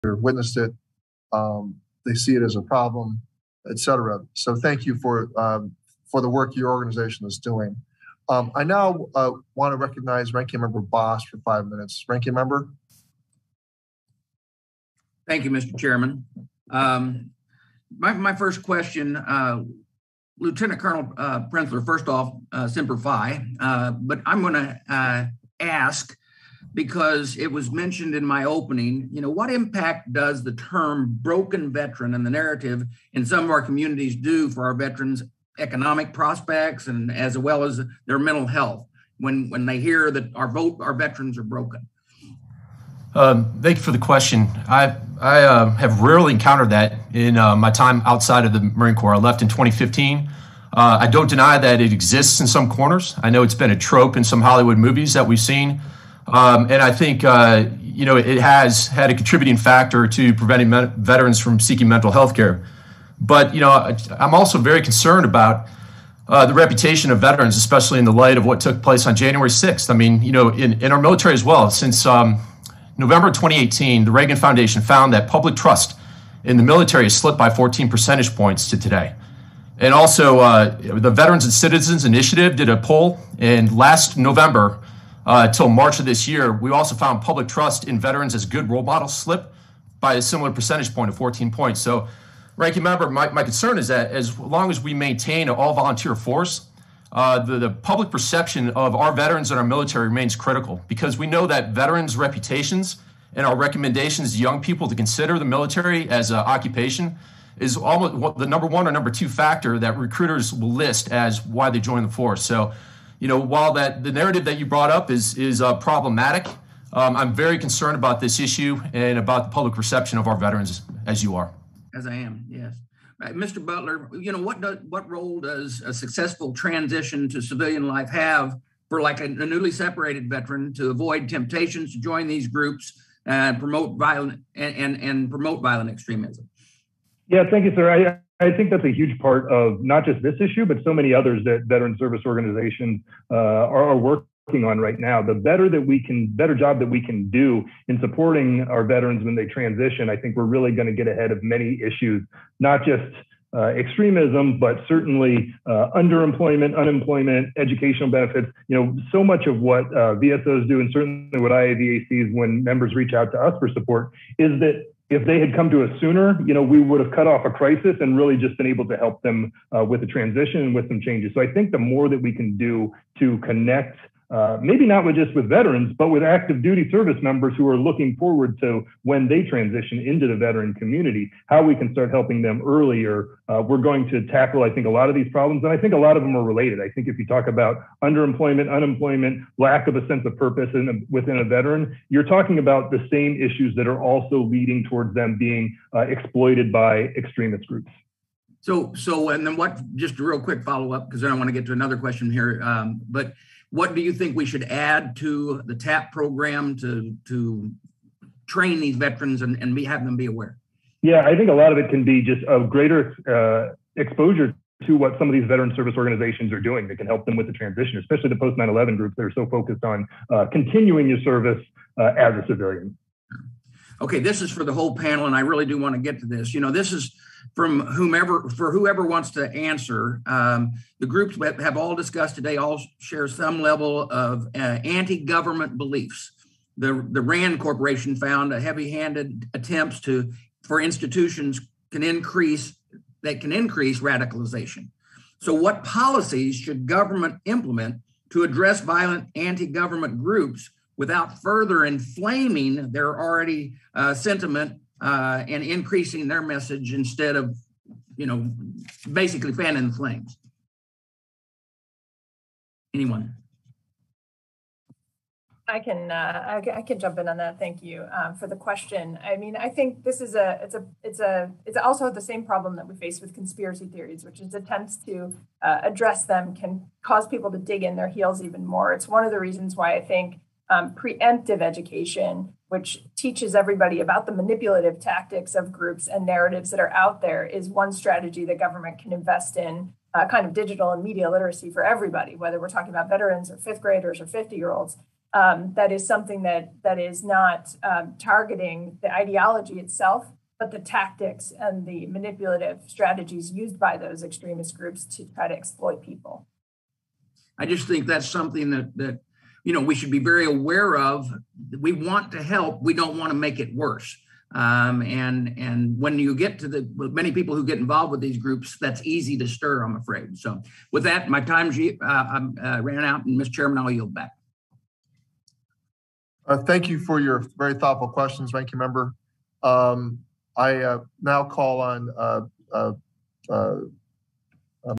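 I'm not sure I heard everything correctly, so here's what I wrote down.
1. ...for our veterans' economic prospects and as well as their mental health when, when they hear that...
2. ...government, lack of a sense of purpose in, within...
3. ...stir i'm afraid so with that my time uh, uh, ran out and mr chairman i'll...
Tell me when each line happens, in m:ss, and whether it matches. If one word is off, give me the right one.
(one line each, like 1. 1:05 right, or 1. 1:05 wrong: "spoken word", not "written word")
1. 0:34 right
2. 3:08 wrong: "unemployment", not "government"
3. 5:19 right.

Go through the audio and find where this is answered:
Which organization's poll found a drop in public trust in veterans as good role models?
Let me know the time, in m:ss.
1:21.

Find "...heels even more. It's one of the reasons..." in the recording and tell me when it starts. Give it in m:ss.
4:38.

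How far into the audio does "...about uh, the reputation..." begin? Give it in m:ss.
1:05.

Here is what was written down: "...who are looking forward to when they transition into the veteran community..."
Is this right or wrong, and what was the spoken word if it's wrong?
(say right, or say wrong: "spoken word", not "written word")
right.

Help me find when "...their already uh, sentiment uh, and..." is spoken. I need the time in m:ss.
4:12.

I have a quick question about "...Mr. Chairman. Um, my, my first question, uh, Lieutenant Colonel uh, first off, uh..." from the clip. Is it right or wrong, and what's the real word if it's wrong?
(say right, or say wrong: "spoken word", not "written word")
right.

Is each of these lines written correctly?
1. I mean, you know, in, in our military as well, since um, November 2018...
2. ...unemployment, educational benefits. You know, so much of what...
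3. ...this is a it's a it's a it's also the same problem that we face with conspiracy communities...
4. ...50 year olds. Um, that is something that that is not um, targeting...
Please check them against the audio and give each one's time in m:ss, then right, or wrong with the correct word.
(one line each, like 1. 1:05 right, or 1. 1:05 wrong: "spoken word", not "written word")
1. 1:09 right
2. 2:36 right
3. 4:30 wrong: "theories", not "communities"
4. 4:54 right.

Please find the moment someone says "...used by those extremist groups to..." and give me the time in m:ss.
5:03.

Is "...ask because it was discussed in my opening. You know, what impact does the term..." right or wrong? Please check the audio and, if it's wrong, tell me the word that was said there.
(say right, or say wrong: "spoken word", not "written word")
wrong: "mentioned", not "discussed".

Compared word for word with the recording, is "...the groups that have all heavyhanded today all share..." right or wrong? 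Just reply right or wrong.
wrong.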